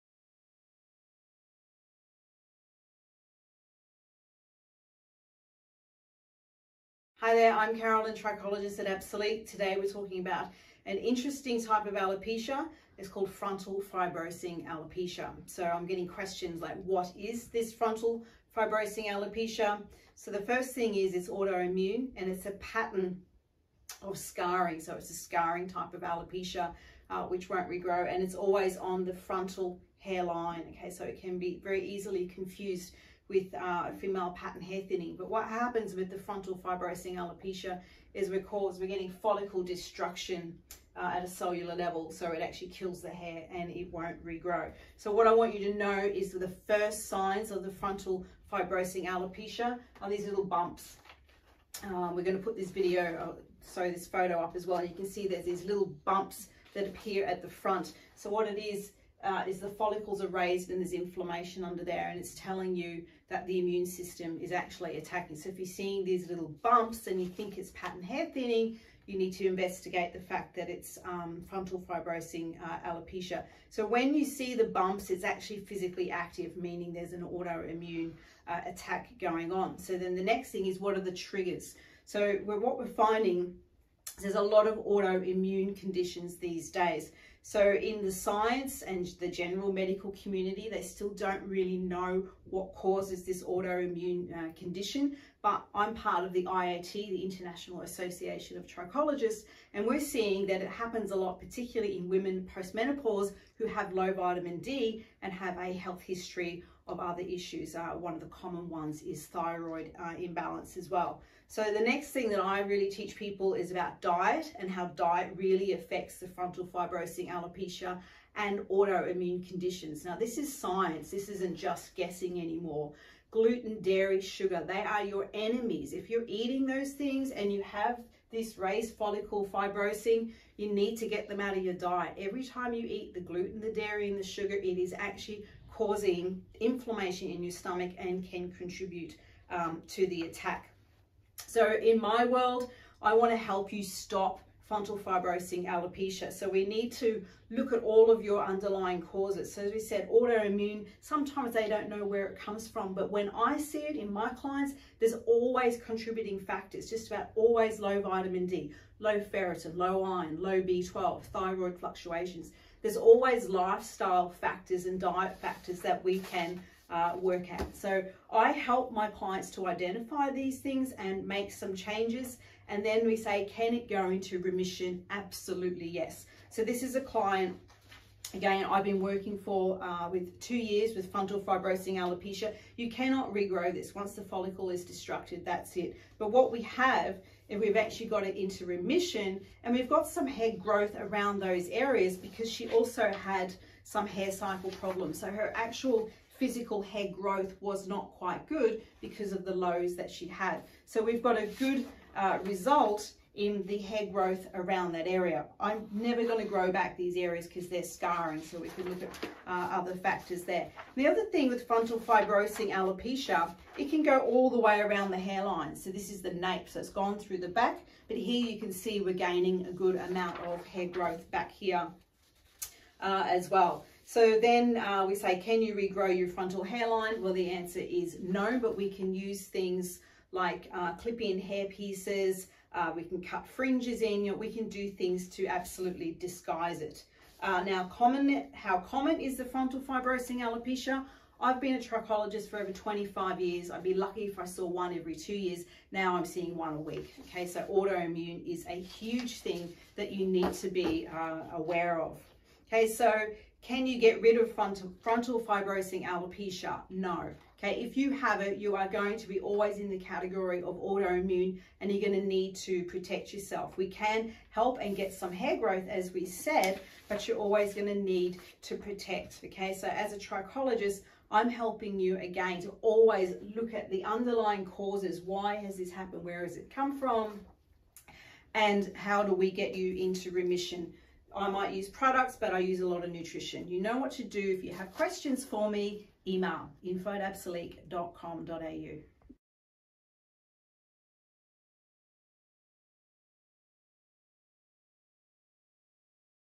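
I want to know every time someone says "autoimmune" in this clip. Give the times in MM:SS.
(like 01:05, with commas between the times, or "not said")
00:21, 01:17, 01:24, 01:33, 01:58, 02:30, 04:07, 04:20.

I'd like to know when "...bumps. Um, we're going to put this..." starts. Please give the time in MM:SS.
00:50.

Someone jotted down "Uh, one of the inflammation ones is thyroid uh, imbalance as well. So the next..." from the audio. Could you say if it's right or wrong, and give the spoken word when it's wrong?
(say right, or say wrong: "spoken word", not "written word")
wrong: "common", not "inflammation".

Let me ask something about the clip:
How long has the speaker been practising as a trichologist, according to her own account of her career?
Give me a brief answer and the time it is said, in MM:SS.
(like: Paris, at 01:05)
Over 25 years, at 04:02.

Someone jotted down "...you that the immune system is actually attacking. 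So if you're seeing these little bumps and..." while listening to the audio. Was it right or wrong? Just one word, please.
right.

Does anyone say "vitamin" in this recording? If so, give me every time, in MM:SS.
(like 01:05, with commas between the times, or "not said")
01:44, 02:38.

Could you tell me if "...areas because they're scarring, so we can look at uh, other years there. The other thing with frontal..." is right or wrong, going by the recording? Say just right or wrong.
wrong.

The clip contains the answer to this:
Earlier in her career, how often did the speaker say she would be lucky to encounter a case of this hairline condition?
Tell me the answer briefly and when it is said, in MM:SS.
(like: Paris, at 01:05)
One every two years, at 04:04.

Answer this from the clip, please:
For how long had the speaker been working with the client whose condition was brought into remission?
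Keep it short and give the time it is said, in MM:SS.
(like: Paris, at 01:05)
2 years, at 03:00.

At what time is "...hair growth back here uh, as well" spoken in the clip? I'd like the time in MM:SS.
03:40.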